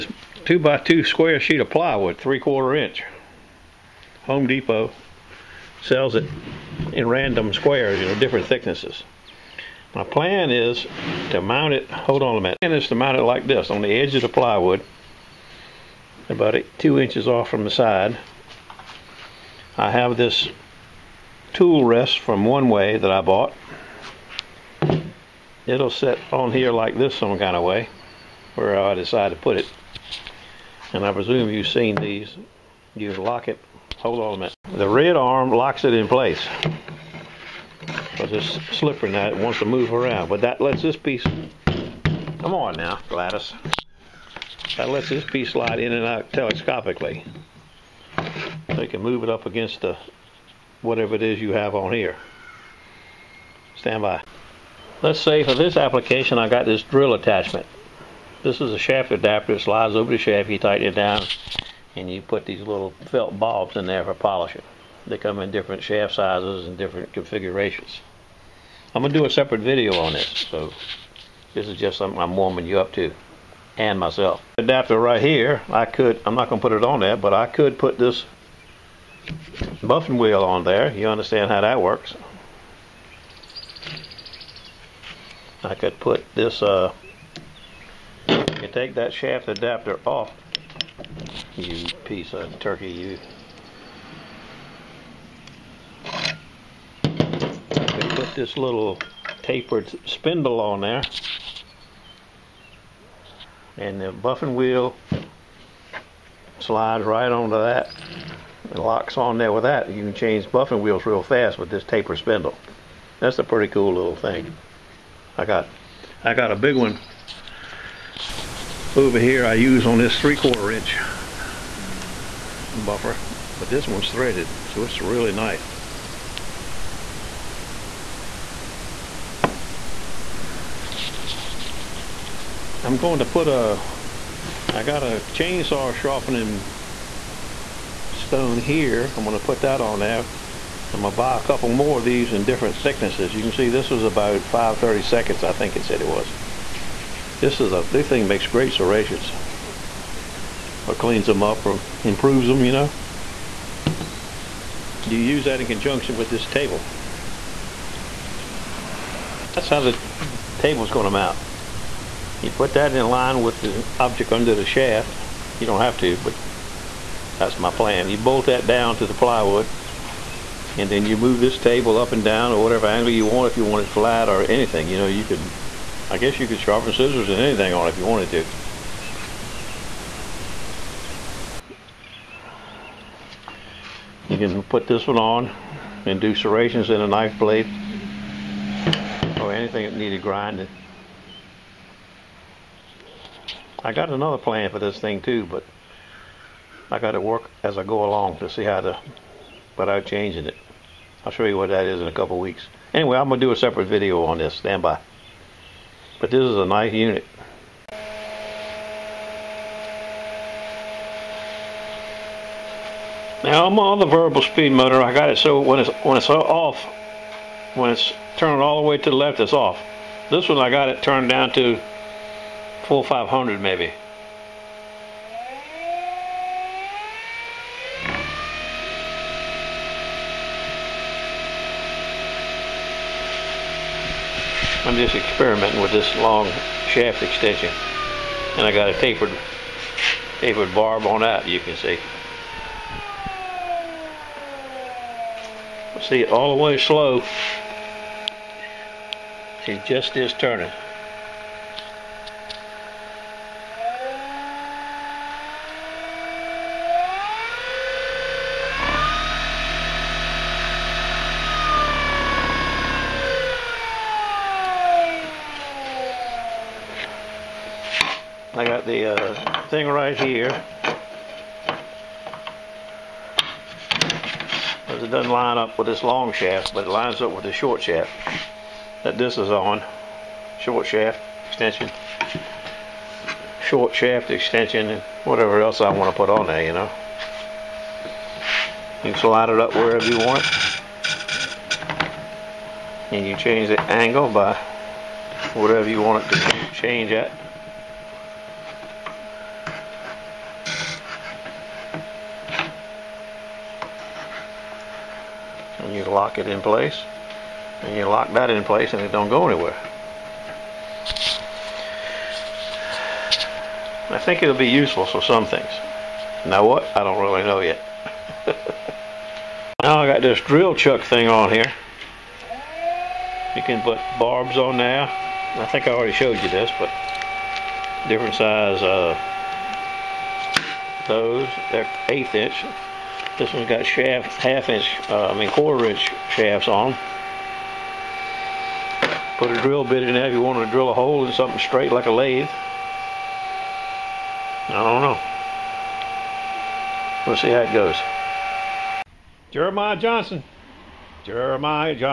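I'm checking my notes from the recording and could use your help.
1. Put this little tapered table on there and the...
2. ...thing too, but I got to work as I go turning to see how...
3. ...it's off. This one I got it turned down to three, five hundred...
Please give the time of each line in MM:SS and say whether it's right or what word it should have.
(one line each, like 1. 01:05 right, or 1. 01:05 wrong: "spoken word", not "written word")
1. 01:37 wrong: "spindle", not "table"
2. 03:14 wrong: "along", not "turning"
3. 03:39 wrong: "four", not "three".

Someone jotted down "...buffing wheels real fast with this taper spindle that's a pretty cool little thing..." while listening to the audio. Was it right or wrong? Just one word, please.
right.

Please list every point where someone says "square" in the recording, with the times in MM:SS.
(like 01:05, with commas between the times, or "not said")
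00:01, 00:07.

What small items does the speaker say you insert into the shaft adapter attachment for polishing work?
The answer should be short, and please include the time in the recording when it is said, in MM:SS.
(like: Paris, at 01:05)
felt balls, at 01:03.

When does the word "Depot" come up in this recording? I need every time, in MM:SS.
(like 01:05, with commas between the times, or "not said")
00:04.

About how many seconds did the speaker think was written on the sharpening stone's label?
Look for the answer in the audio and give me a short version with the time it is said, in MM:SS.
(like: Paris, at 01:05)
530, at 02:24.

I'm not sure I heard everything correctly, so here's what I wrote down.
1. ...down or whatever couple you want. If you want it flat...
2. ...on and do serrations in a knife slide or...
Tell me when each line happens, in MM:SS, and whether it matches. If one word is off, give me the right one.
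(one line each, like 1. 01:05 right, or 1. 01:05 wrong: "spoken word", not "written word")
1. 02:52 wrong: "angle", not "couple"
2. 03:05 wrong: "blade", not "slide".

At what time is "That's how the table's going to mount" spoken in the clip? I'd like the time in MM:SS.
02:39.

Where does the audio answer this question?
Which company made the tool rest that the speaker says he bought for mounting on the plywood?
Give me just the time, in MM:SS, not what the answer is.
00:22.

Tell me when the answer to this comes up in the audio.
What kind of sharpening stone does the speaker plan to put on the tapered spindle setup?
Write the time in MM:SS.
02:15.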